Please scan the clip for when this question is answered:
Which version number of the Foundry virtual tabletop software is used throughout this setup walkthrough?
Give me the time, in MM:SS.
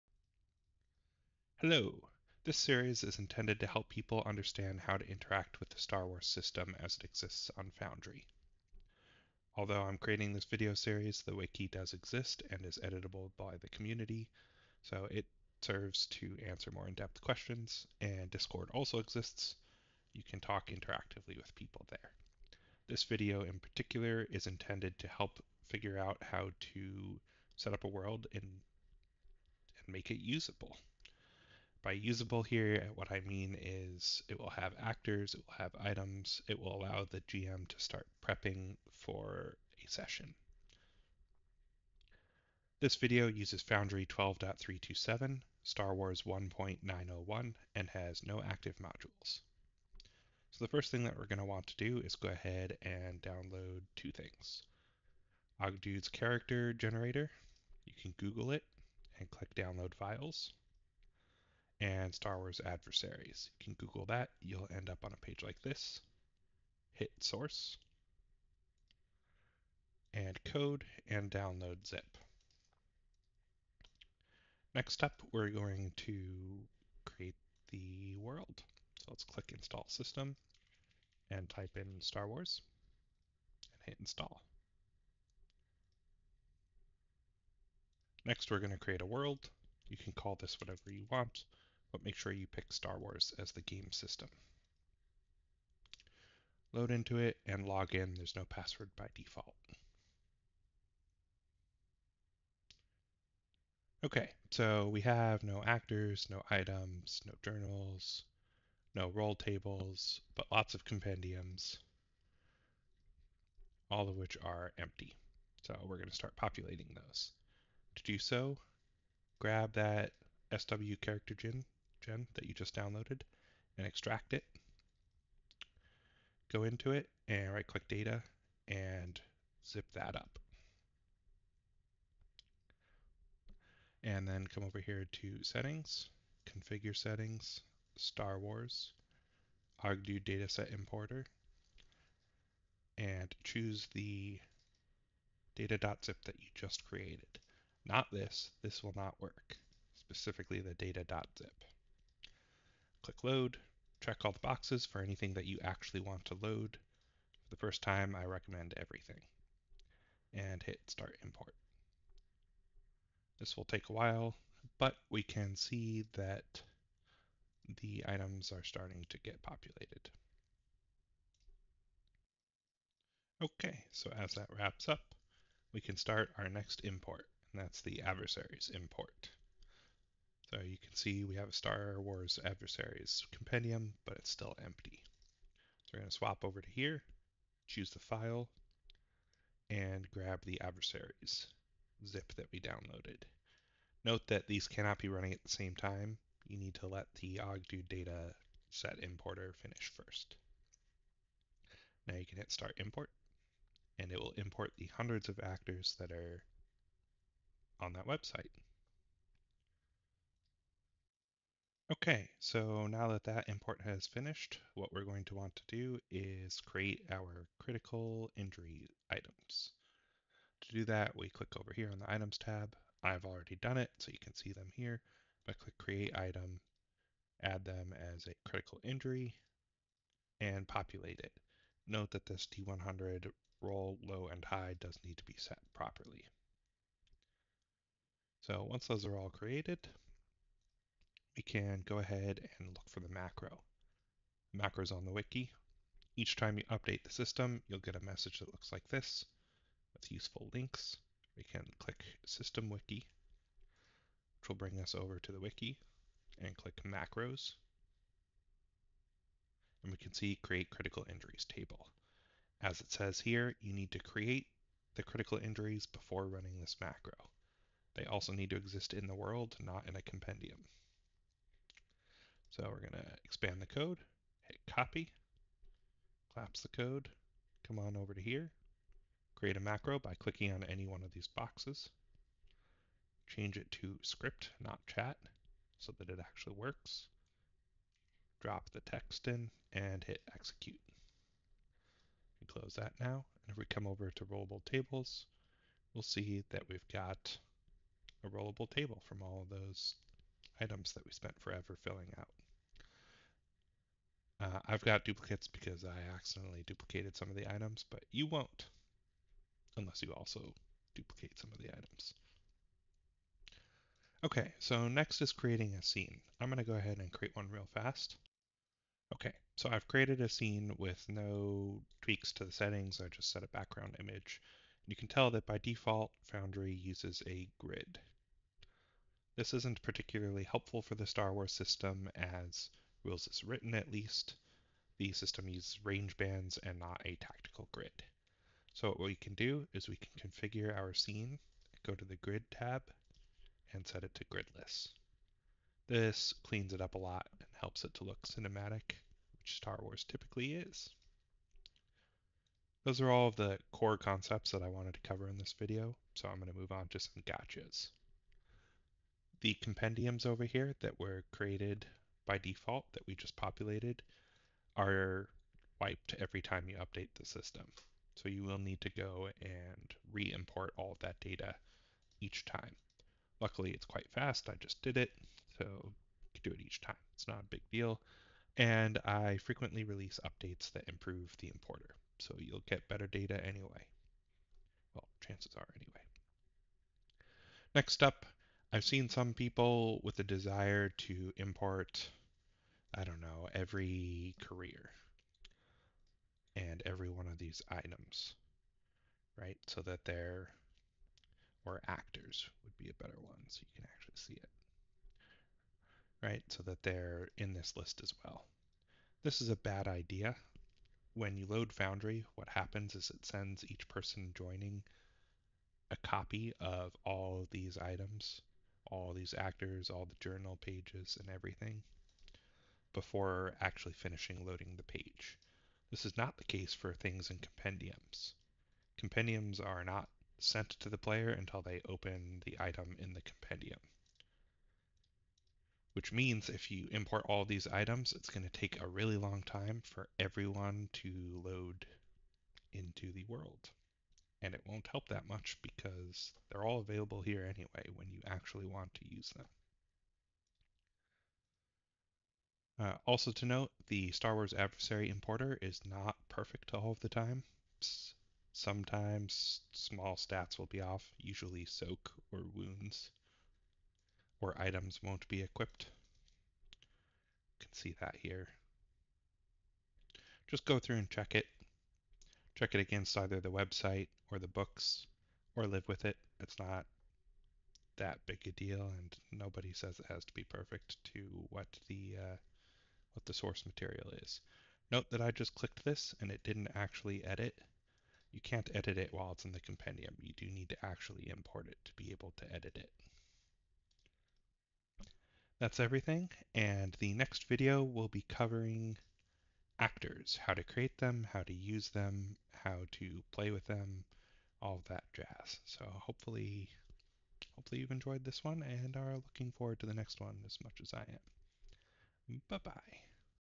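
00:44.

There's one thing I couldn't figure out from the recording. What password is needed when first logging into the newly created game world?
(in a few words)
There's no password.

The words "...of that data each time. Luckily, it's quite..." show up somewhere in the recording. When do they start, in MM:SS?
06:10.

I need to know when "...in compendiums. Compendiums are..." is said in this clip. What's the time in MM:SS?
07:07.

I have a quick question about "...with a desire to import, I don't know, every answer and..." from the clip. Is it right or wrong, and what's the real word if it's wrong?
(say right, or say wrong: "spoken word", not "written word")
wrong: "career", not "answer".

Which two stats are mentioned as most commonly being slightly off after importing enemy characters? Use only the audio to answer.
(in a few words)
soak or wounds.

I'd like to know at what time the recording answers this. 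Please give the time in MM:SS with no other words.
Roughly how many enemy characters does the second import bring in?
03:24.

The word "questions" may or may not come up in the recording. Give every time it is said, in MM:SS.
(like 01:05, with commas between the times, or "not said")
00:17.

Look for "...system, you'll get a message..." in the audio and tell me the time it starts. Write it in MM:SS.
04:07.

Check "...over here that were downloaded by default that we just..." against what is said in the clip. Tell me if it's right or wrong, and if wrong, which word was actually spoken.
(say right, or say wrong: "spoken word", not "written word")
wrong: "created", not "downloaded".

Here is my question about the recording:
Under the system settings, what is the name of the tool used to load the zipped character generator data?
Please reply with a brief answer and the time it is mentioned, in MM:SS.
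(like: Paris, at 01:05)
Oggdude dataset importer, at 02:19.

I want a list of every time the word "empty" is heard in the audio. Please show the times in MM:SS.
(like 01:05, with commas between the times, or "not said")
01:54, 03:04.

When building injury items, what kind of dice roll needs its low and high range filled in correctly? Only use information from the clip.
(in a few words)
D100.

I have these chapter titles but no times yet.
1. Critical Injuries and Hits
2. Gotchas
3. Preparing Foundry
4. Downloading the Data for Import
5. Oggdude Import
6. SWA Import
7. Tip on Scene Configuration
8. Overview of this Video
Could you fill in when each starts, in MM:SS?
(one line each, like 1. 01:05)
1. 03:32
2. 05:52
3. 01:13
4. 00:49
5. 01:43
6. 02:54
7. 05:14
8. 00:22.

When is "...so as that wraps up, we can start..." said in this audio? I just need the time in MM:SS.
02:53.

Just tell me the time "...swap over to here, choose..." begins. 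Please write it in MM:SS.
03:06.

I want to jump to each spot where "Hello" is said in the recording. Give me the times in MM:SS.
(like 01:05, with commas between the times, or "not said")
00:01.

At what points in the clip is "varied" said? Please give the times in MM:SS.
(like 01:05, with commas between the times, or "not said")
not said.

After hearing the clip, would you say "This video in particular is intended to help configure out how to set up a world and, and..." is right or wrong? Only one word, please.
wrong.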